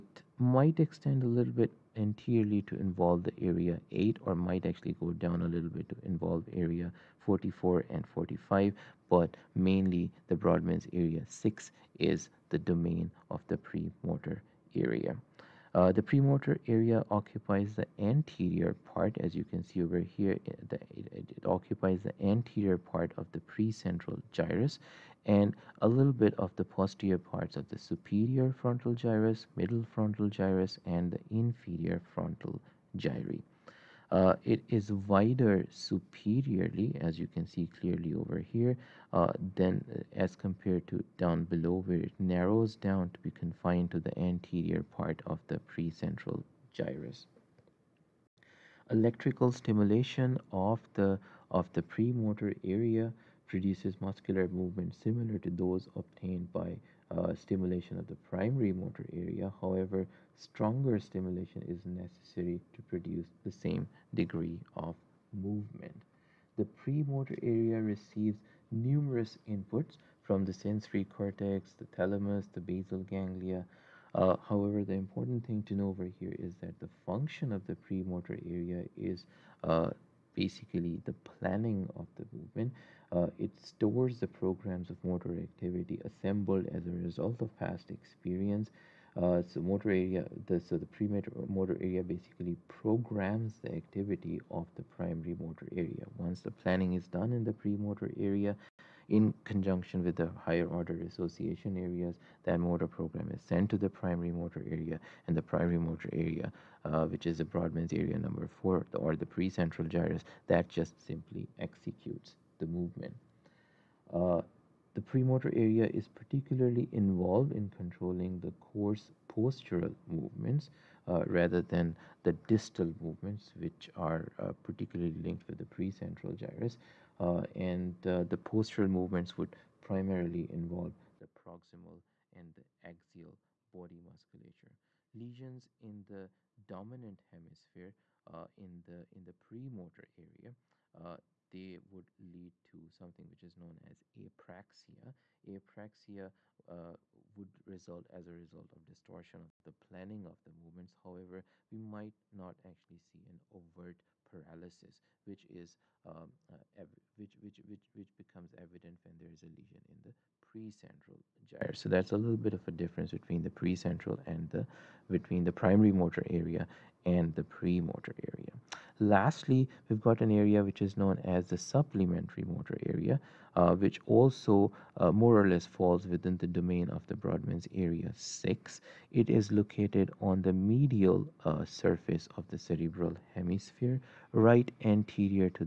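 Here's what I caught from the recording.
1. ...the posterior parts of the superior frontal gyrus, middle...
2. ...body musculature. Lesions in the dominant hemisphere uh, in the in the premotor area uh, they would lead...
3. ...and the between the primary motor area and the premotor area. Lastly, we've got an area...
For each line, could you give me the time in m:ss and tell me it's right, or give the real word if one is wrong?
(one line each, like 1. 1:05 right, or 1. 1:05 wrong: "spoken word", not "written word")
1. 0:26 right
2. 2:13 right
3. 2:44 right.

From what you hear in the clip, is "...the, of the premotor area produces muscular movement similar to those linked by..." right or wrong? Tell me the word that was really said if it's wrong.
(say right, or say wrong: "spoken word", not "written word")
wrong: "obtained", not "linked".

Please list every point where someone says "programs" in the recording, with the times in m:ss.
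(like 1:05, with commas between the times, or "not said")
1:24, 1:32, 1:42.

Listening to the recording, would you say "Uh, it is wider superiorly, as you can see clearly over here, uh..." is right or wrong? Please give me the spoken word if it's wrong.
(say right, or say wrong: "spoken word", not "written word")
right.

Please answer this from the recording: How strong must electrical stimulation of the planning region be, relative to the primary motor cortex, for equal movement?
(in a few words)
Stronger stimulation.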